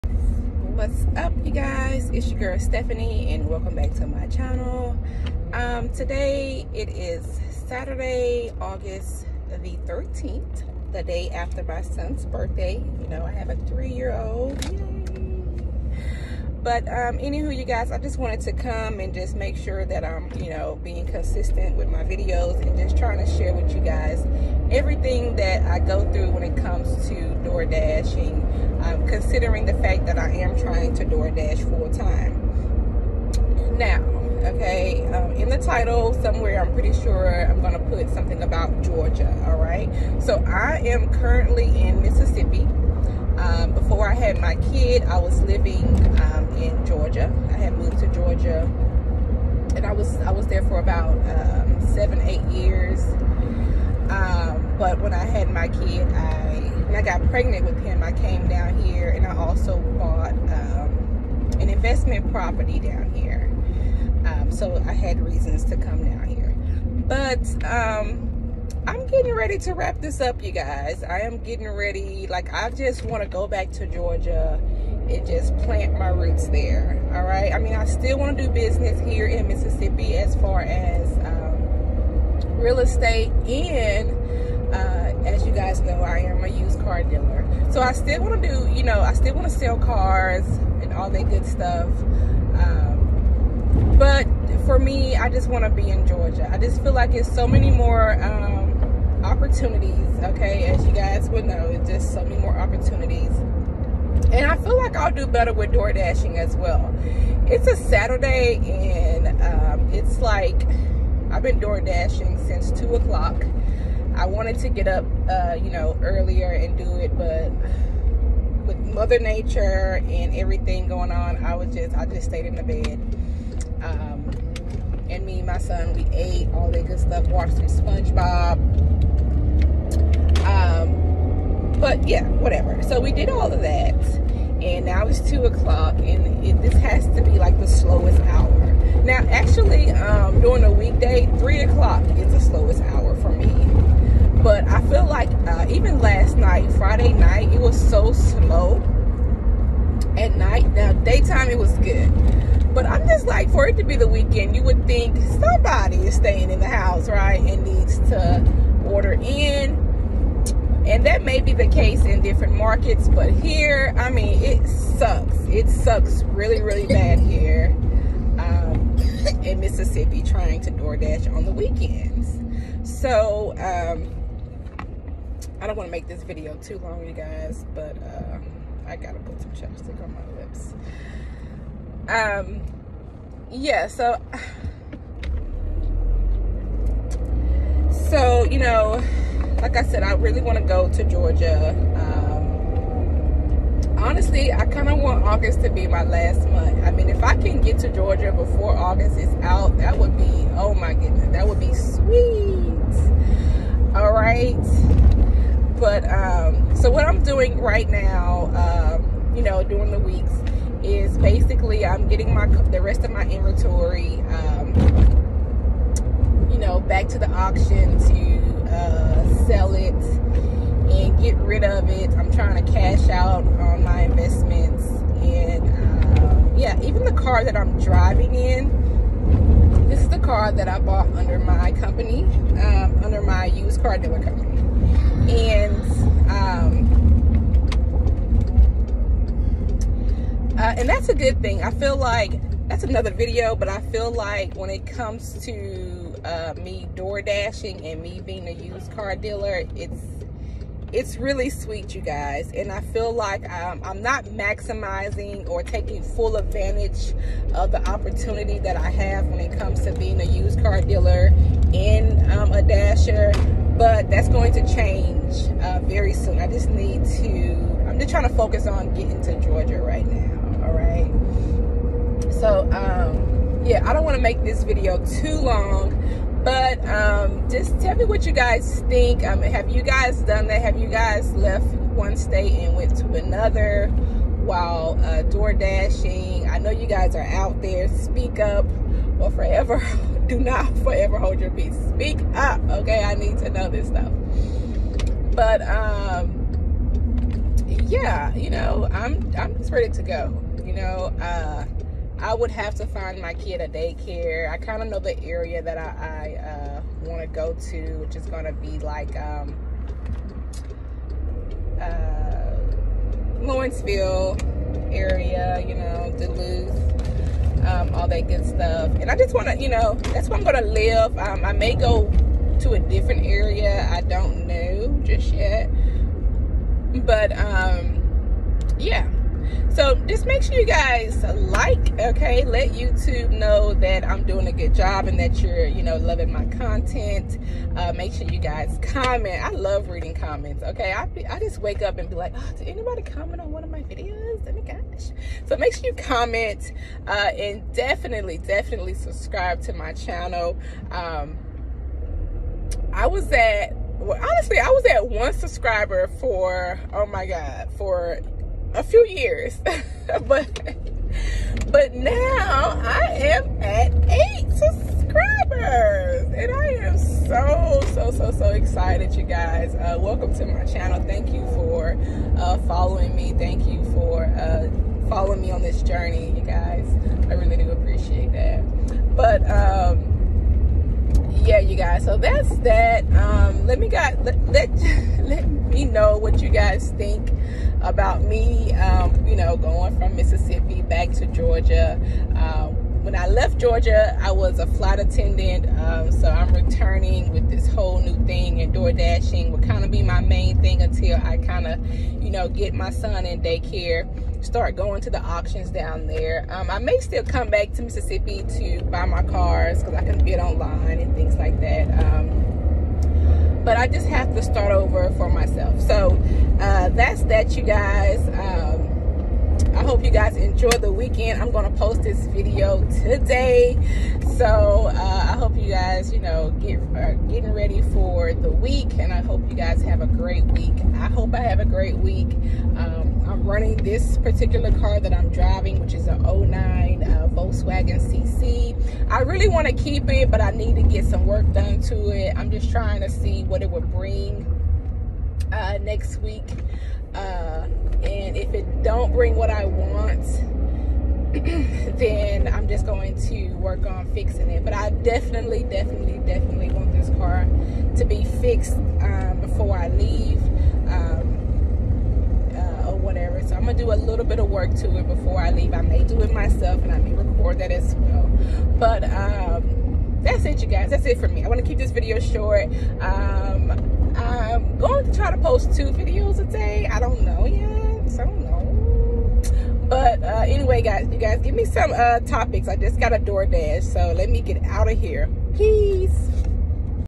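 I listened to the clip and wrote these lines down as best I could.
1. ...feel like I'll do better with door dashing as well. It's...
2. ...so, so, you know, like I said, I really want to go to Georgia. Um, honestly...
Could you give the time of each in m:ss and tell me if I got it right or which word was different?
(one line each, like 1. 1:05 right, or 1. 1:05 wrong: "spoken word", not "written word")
1. 1:44 right
2. 3:03 right.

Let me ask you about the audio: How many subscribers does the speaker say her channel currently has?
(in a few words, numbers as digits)
8.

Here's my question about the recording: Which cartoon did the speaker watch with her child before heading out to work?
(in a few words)
SpongeBob.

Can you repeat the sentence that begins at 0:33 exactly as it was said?
Now, okay, um, in the title somewhere, I'm pretty sure I'm going to put something about Georgia, all right?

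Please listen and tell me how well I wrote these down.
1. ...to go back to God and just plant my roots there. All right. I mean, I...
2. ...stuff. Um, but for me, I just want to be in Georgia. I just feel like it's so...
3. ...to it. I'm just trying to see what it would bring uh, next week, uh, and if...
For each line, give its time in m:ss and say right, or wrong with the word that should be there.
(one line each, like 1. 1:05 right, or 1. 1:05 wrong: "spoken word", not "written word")
1. 1:13 wrong: "Georgia", not "God"
2. 1:31 right
3. 7:21 right.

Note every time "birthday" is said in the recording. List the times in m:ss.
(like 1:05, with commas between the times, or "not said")
0:12.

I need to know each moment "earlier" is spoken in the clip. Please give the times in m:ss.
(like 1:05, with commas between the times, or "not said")
1:56.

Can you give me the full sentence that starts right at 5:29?
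So just make sure you guys like, okay?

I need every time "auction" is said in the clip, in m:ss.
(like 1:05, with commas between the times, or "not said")
3:37, 6:45.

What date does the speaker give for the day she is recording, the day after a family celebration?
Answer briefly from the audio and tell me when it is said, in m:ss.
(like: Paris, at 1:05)
August 13th, at 0:08.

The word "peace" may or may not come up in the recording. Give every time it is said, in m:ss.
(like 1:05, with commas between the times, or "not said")
4:51, 8:05.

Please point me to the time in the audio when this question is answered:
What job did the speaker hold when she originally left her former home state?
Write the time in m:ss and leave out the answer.
6:34.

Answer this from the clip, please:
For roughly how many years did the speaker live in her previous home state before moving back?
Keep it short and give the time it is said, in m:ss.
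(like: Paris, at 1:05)
7 or 8 years, at 0:51.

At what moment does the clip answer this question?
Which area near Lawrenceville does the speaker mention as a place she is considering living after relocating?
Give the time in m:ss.
5:16.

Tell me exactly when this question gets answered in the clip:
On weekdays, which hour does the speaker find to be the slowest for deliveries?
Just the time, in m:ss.
2:21.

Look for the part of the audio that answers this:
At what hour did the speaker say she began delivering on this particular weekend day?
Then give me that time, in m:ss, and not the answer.
1:52.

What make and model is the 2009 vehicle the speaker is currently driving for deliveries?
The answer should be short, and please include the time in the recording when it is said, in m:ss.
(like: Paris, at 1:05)
Volkswagen CC, at 7:17.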